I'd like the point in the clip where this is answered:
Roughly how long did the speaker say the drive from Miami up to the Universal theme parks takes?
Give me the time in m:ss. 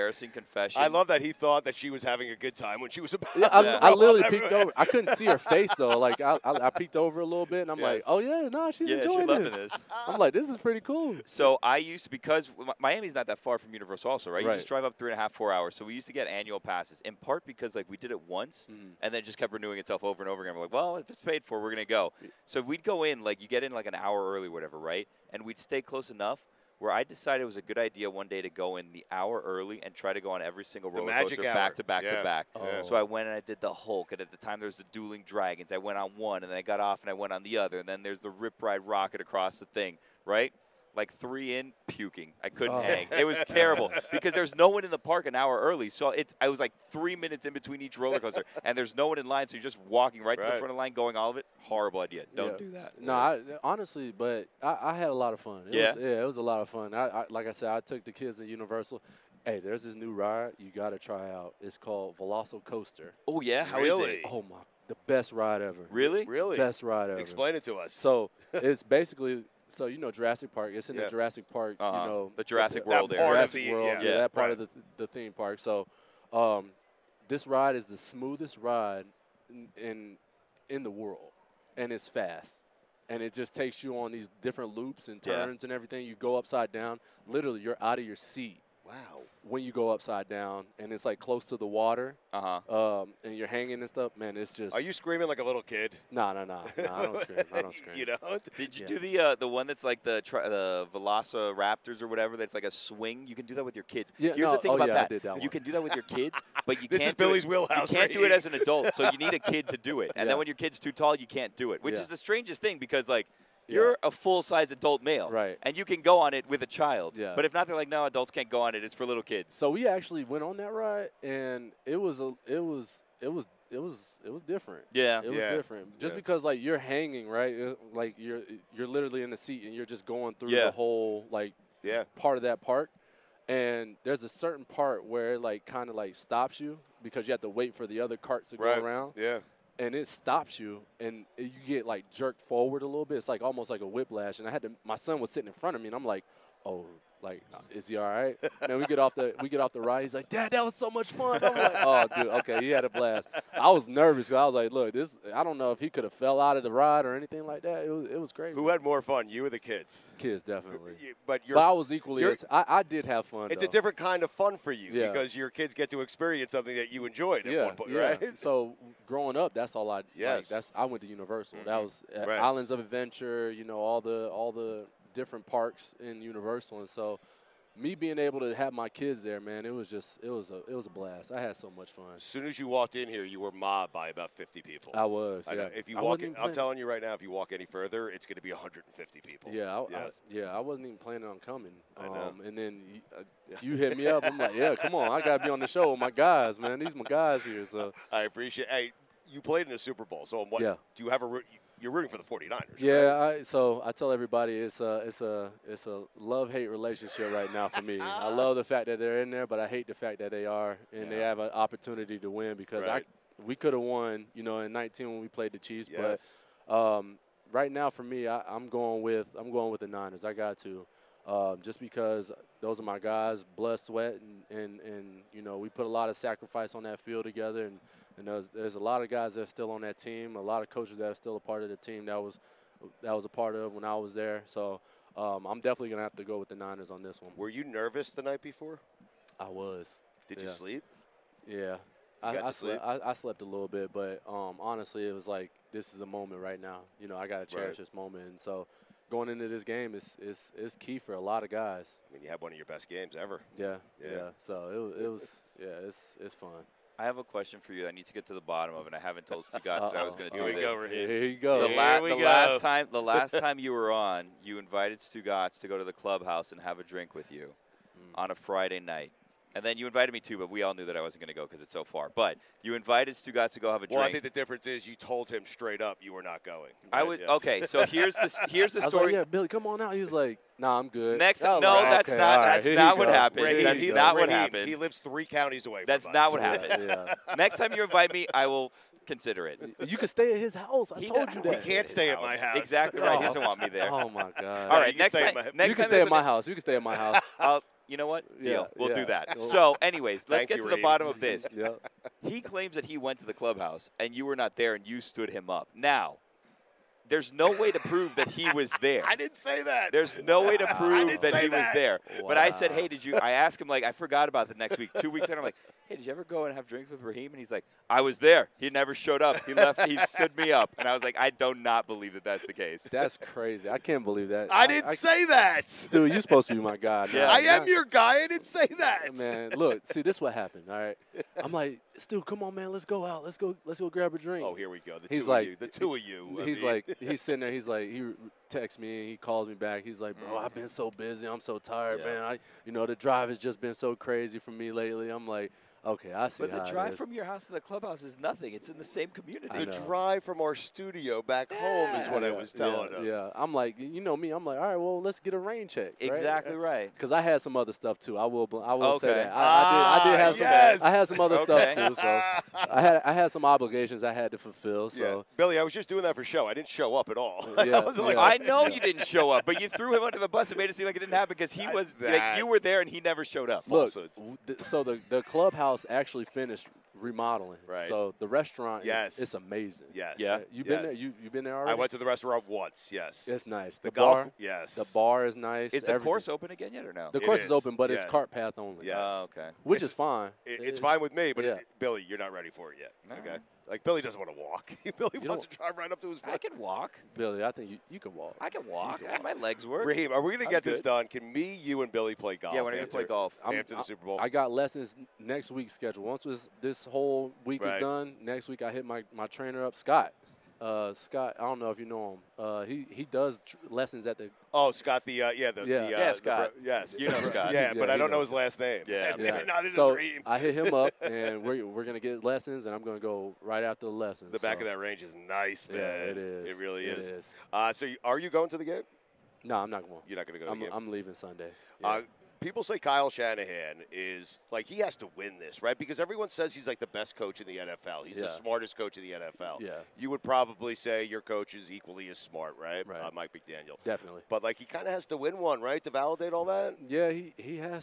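0:14.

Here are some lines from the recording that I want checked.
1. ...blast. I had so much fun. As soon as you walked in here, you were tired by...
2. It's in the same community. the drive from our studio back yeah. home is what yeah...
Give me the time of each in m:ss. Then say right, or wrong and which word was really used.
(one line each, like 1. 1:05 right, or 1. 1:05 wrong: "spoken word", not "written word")
1. 3:00 wrong: "mobbed", not "tired"
2. 5:48 right.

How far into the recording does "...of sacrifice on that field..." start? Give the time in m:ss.
3:46.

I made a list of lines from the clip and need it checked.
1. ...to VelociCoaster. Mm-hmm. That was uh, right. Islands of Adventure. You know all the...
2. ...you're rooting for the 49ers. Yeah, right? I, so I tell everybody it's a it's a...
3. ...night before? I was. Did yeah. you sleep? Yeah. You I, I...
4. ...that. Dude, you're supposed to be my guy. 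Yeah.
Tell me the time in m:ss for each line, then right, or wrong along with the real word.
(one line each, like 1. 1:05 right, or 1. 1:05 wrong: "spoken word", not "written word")
1. 2:51 wrong: "Universal", not "VelociCoaster"
2. 3:21 right
3. 3:58 right
4. 5:25 right.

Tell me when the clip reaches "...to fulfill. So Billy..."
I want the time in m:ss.
6:04.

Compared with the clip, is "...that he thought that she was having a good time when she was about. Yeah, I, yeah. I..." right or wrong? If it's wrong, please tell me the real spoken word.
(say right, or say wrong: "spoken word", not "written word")
right.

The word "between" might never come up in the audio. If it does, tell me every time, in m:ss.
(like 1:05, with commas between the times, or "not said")
0:47.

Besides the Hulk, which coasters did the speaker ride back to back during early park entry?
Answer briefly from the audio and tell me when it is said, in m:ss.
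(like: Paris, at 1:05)
Dueling Dragons, at 0:34.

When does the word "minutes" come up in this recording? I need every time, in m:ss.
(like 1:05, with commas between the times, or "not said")
0:47.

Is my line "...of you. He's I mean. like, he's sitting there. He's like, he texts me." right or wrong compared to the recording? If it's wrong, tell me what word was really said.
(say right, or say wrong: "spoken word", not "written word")
right.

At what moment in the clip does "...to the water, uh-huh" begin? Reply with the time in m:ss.
1:31.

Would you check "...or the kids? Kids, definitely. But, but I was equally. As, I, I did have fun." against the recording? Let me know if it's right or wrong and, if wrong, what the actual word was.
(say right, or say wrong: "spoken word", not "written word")
right.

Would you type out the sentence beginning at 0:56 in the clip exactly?
I, I, like I said, I took the kids to Universal.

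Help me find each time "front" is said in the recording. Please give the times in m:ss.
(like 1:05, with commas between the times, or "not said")
0:50, 2:25.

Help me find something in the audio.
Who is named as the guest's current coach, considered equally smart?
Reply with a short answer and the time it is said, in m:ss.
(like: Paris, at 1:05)
Mike McDaniel, at 7:23.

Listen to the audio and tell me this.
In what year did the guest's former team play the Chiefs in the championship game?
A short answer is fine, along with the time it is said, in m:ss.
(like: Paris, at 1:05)
2019, at 3:34.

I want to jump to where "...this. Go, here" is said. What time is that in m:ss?
4:20.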